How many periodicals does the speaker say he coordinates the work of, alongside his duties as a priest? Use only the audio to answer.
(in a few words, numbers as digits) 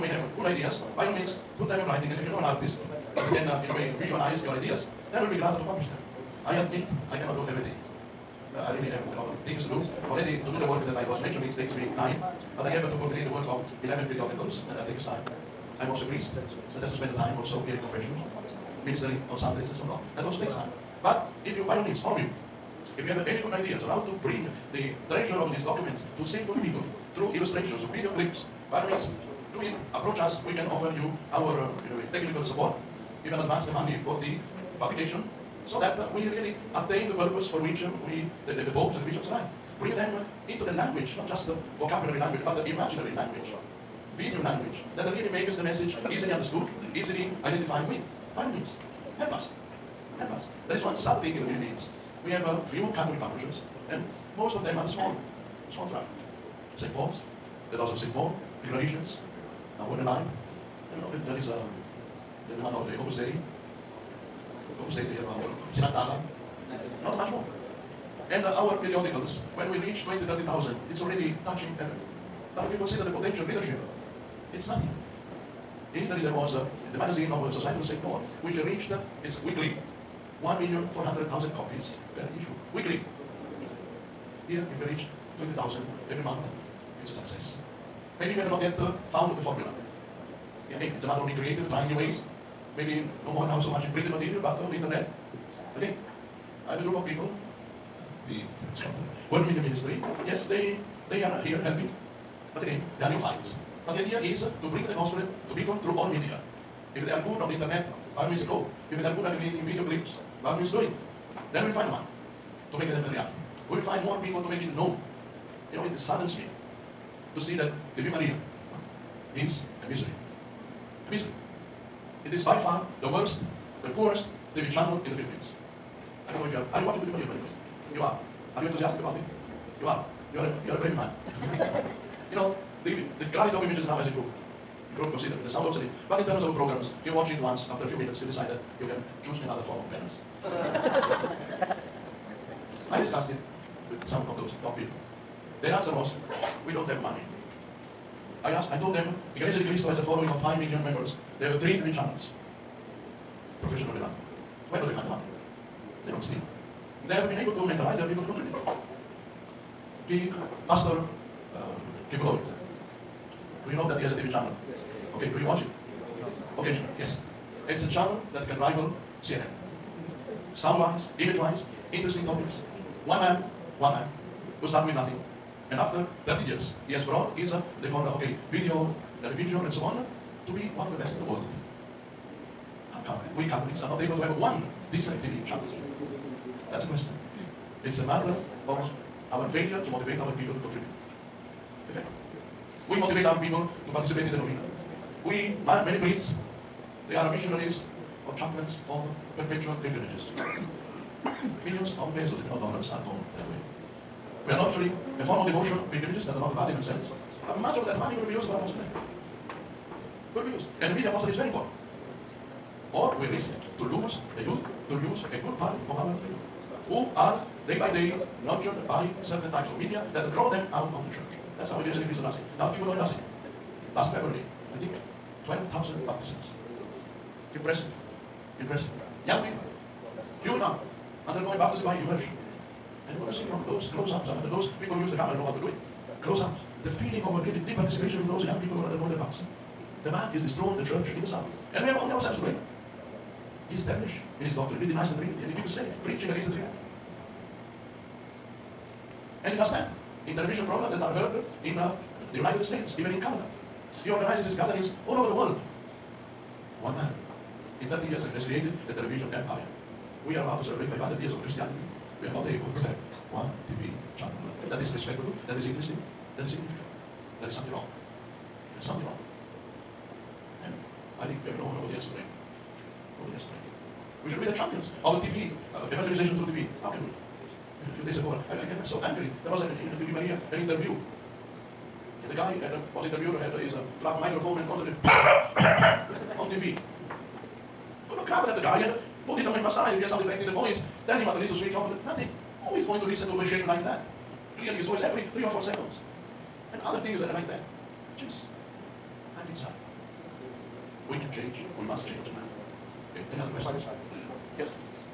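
11.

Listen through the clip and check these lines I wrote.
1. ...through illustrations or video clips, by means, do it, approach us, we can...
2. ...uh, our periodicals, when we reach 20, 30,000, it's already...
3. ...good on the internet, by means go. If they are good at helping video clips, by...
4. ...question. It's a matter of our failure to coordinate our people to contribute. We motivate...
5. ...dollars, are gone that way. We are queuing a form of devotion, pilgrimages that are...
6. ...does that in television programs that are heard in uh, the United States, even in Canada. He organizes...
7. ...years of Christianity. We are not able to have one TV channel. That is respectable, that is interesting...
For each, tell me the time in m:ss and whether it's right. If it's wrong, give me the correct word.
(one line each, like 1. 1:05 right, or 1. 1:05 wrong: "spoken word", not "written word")
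1. 0:27 right
2. 1:08 right
3. 1:47 wrong: "creating", not "helping"
4. 3:06 wrong: "motivate", not "coordinate"
5. 3:22 wrong: "nurturing", not "queuing"
6. 4:09 right
7. 4:21 right.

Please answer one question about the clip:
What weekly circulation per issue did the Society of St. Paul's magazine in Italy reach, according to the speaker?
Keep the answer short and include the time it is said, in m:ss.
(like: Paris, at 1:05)
1,400,000, at 1:20.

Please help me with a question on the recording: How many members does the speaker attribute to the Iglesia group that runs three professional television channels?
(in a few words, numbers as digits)
5 million.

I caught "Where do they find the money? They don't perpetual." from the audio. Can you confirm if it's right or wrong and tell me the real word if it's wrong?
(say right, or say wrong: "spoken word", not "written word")
wrong: "steal", not "perpetual".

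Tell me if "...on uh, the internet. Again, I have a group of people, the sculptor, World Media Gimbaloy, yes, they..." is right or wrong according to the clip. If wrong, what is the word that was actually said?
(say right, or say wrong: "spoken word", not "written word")
wrong: "Ministry", not "Gimbaloy".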